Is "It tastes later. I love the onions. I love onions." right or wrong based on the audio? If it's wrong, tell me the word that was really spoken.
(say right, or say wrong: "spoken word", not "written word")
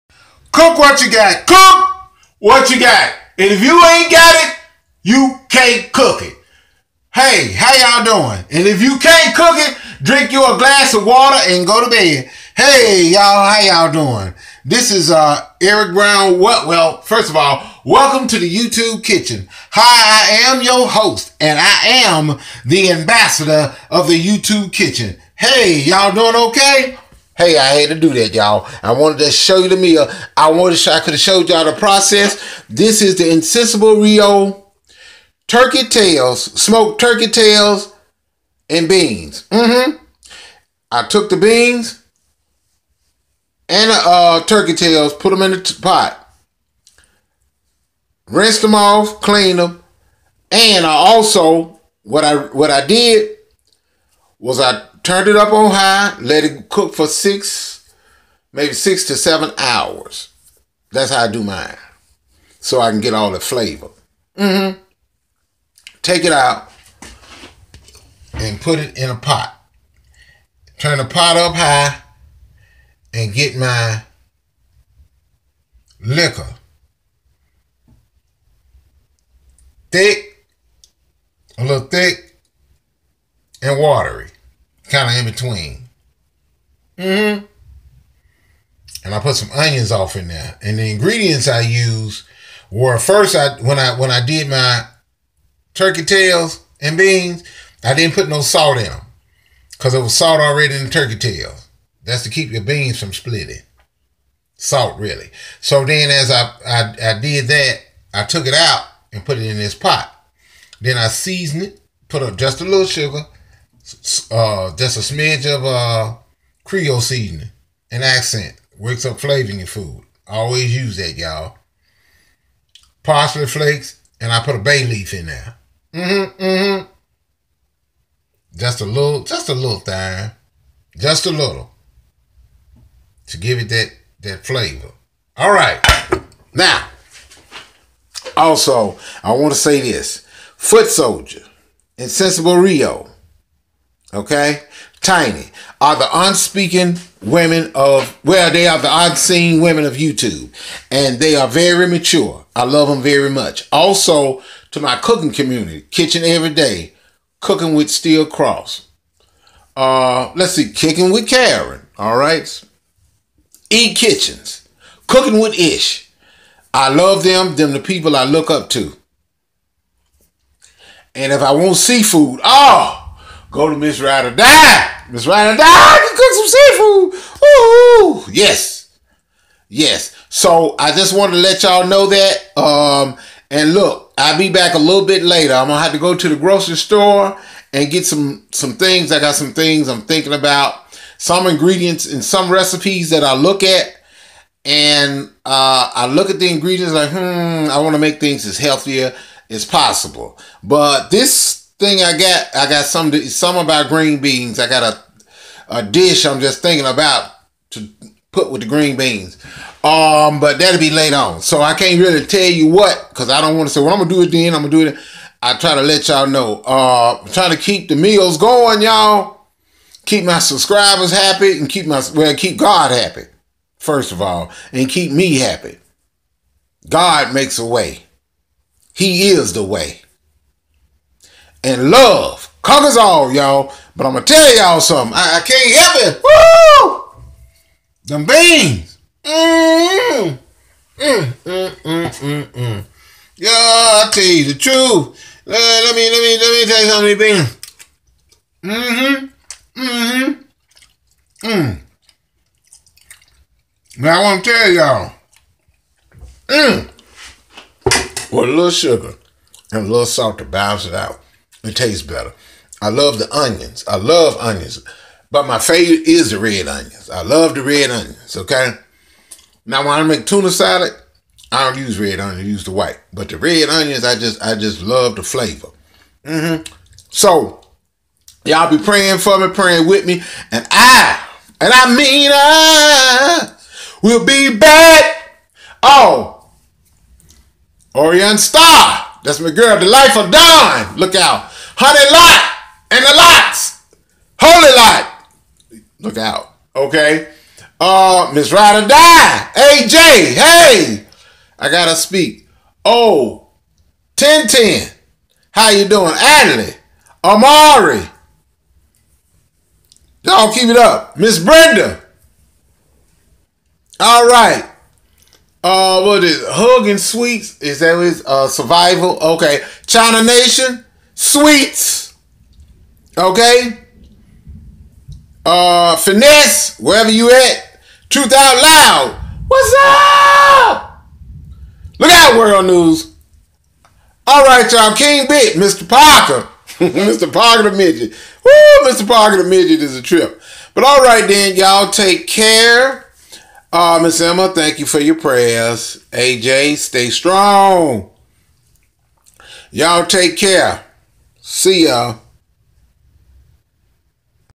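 wrong: "better", not "later".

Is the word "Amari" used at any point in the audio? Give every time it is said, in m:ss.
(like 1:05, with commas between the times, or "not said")
5:07.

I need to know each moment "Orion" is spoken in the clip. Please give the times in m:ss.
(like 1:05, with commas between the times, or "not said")
4:47.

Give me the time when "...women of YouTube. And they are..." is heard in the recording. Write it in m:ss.
2:29.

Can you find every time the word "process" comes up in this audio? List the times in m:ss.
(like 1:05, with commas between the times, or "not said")
0:31.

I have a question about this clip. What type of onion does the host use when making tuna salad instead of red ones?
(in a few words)
white.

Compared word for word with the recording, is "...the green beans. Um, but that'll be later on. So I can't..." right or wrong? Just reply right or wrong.
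right.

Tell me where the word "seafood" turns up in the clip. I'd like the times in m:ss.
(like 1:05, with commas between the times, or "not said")
2:51, 2:56.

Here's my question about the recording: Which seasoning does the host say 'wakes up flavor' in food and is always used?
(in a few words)
Accent.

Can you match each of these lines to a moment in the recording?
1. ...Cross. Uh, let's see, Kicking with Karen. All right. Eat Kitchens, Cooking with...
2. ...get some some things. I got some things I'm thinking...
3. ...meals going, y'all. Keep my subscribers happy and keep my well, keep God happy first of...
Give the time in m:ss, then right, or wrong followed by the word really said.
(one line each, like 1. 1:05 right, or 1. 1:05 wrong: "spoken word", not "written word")
1. 2:38 right
2. 3:07 right
3. 3:37 right.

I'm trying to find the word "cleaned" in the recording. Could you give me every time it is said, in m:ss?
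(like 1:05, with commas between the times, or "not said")
0:49.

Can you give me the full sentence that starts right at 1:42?
That's to keep your beans from splitting.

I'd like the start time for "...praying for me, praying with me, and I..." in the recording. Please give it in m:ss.
4:38.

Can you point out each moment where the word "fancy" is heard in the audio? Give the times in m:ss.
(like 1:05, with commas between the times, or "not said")
not said.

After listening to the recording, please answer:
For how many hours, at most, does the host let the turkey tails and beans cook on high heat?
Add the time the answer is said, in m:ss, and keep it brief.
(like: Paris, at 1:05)
7, at 0:58.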